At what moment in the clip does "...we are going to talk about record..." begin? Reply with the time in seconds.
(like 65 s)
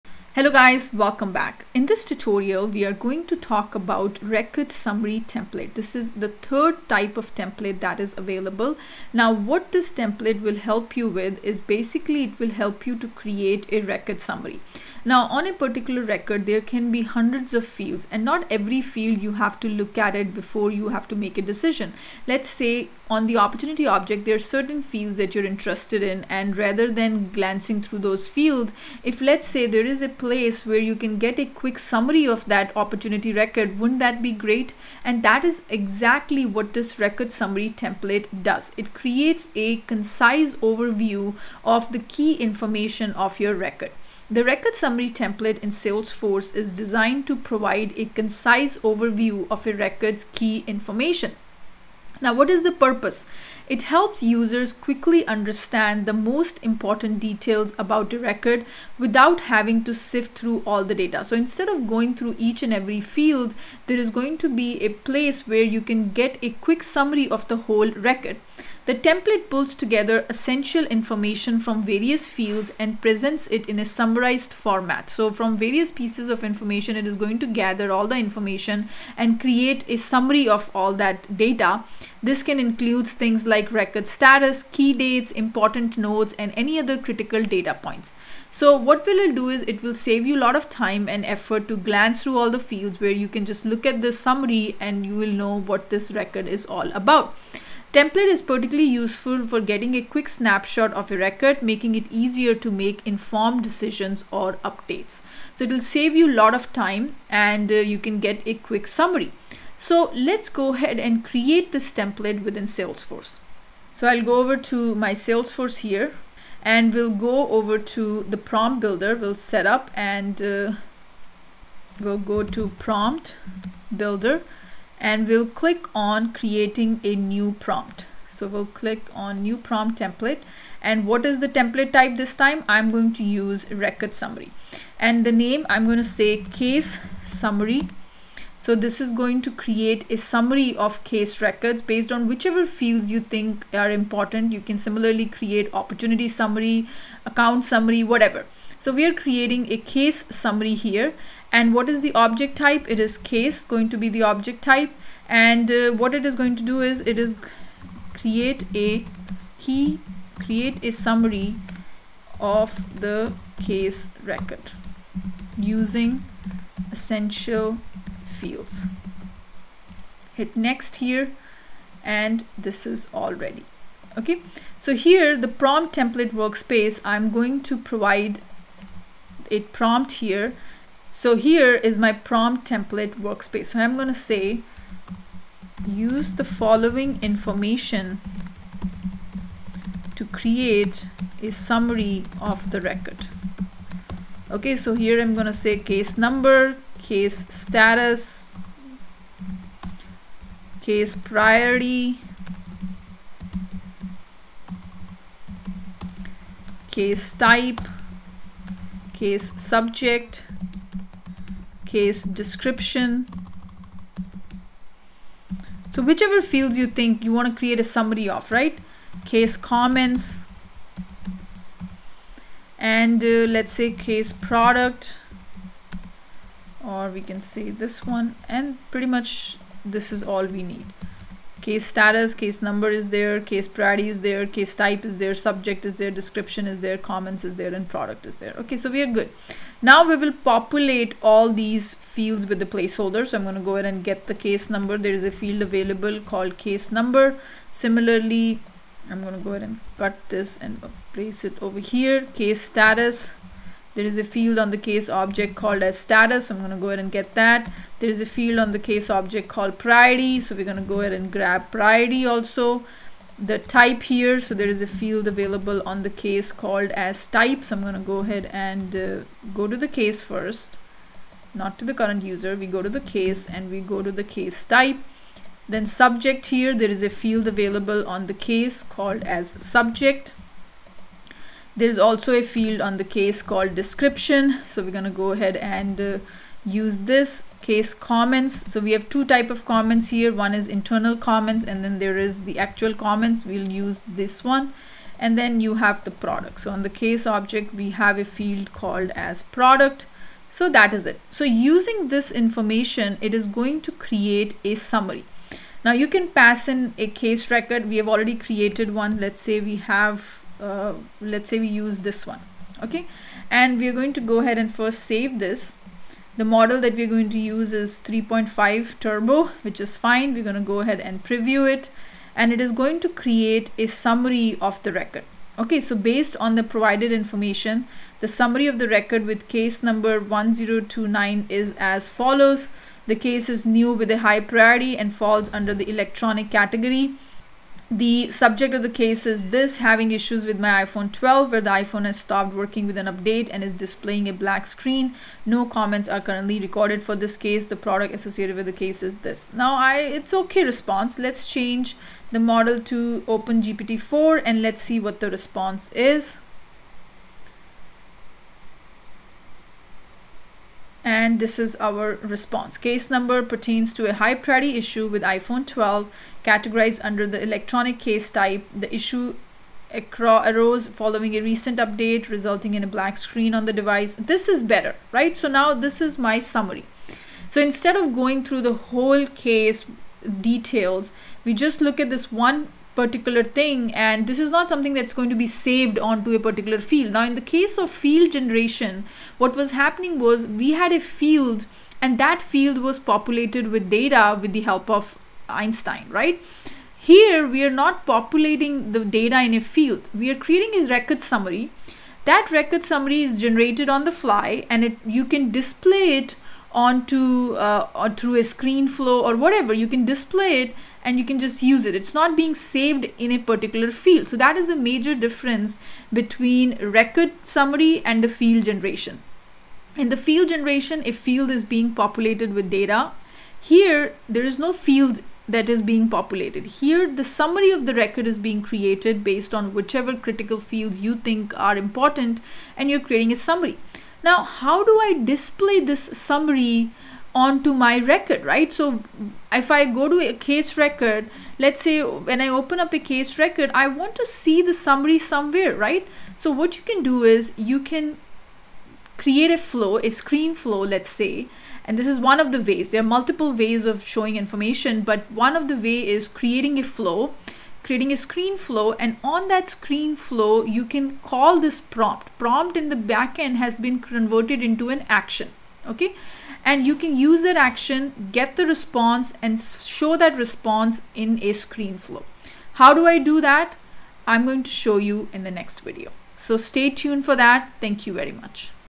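2 s.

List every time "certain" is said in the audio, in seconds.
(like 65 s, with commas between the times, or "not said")
24 s.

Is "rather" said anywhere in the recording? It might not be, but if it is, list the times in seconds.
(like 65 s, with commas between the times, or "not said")
26 s.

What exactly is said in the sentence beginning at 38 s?
It creates a concise overview of the key information of your record.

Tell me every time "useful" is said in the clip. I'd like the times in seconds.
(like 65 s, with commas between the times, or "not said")
98 s.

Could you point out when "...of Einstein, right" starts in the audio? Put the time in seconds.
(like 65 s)
394 s.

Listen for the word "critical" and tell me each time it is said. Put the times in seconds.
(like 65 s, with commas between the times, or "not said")
86 s, 430 s.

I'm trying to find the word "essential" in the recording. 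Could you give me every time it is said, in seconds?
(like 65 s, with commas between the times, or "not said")
70 s, 166 s.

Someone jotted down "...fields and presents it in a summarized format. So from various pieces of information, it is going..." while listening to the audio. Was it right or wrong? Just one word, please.
right.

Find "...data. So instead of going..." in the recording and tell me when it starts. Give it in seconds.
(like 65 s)
60 s.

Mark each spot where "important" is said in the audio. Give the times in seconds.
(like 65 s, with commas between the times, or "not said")
56 s, 85 s, 143 s, 431 s.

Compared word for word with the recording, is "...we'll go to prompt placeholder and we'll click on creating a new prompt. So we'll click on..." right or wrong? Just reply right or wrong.
wrong.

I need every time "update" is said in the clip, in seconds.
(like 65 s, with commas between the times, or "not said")
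104 s, 343 s, 371 s.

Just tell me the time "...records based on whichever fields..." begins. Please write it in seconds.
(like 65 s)
141 s.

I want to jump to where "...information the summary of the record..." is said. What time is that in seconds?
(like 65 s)
327 s.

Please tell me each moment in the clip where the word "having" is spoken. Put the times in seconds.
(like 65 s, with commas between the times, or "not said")
59 s, 339 s.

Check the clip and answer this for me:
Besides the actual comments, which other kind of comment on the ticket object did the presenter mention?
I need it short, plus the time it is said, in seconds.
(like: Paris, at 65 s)
Internal comments, at 290 s.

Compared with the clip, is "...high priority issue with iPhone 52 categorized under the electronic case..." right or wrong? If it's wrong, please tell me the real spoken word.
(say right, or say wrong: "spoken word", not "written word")
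wrong: "12", not "52".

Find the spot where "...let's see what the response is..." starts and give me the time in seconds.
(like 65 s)
354 s.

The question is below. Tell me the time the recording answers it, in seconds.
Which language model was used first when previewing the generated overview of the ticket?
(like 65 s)
318 s.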